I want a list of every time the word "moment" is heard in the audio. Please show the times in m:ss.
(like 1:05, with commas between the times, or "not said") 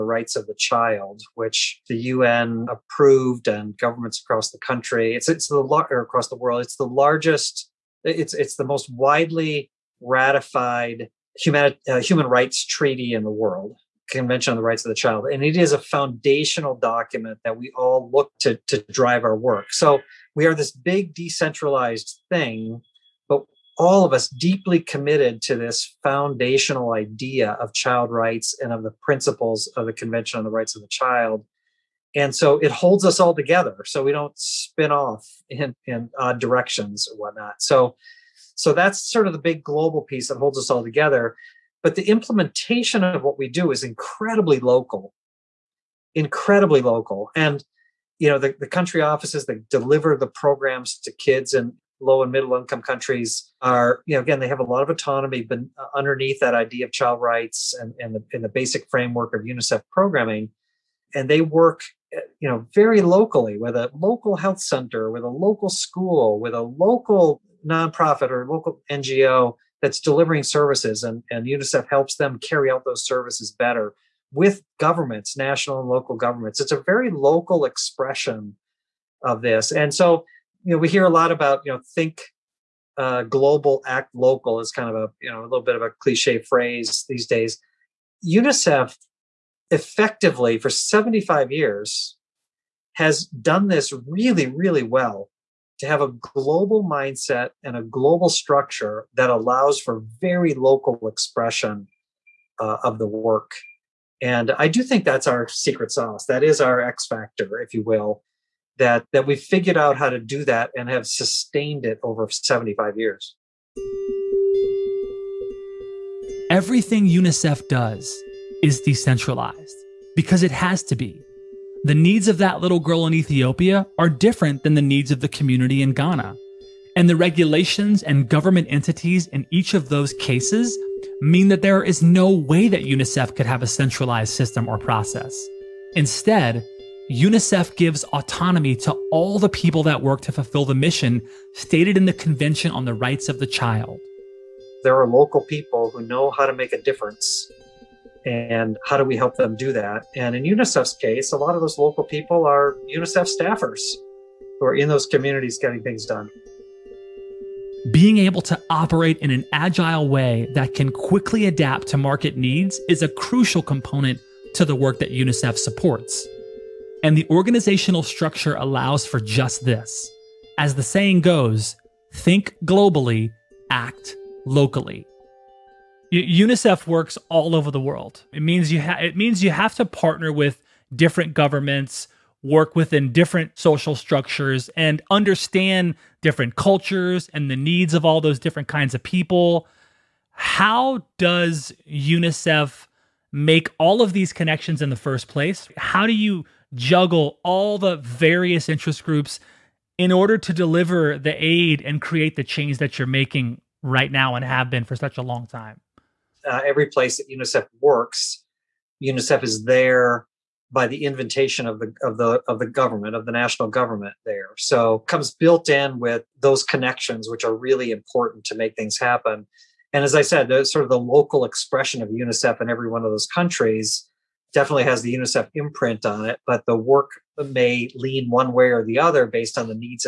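not said.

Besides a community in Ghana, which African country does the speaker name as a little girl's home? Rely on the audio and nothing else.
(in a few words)
Ethiopia.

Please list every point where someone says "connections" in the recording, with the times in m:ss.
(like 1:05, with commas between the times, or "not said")
3:14, 3:36.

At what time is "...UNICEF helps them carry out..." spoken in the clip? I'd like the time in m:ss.
1:11.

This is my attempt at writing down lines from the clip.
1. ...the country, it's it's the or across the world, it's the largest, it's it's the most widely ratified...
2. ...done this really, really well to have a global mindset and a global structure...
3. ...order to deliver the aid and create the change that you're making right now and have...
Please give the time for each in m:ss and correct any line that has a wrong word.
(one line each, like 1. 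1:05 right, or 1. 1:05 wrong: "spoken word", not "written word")
1. 0:04 right
2. 1:33 right
3. 3:20 right.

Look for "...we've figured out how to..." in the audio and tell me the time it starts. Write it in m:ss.
1:49.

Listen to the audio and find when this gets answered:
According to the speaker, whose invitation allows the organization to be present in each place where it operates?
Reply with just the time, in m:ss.
3:33.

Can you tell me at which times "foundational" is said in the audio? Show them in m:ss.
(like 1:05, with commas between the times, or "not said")
0:15, 0:26.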